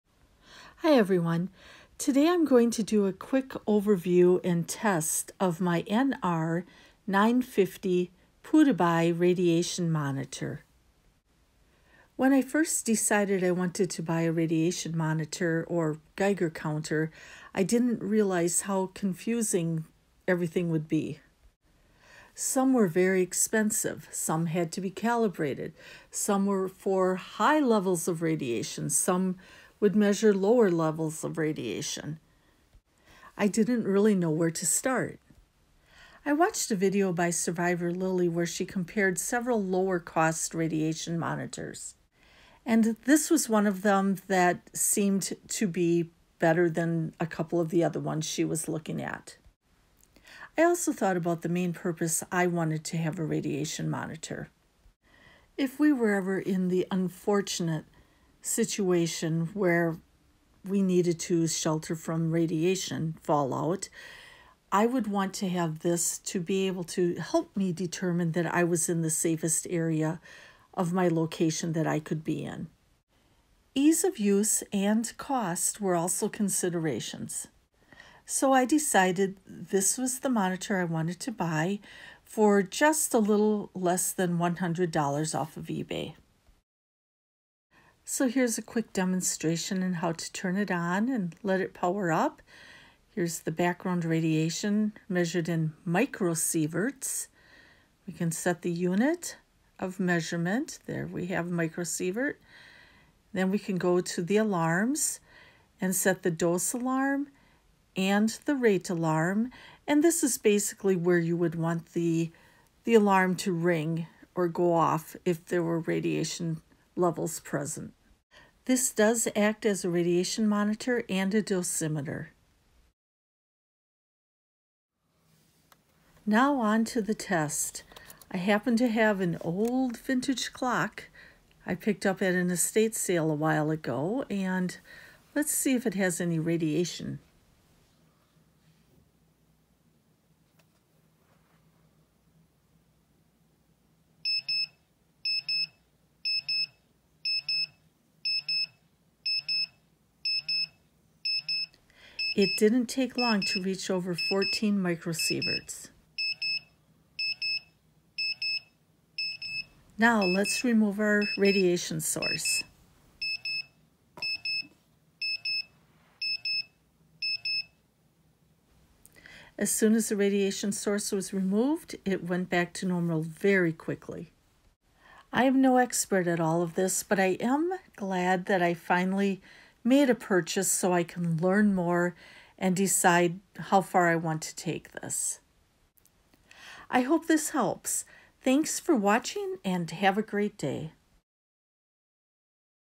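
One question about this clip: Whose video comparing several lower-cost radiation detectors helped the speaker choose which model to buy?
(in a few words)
Survival Lilly.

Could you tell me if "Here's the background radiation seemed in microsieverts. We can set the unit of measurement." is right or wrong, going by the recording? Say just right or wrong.
wrong.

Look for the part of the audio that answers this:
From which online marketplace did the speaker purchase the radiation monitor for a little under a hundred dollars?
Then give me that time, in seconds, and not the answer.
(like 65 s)
85 s.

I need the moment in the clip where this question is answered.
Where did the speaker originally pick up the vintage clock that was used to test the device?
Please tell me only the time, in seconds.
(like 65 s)
132 s.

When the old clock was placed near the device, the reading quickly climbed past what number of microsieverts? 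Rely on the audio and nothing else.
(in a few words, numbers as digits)
14.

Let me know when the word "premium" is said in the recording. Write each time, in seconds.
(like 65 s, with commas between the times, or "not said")
not said.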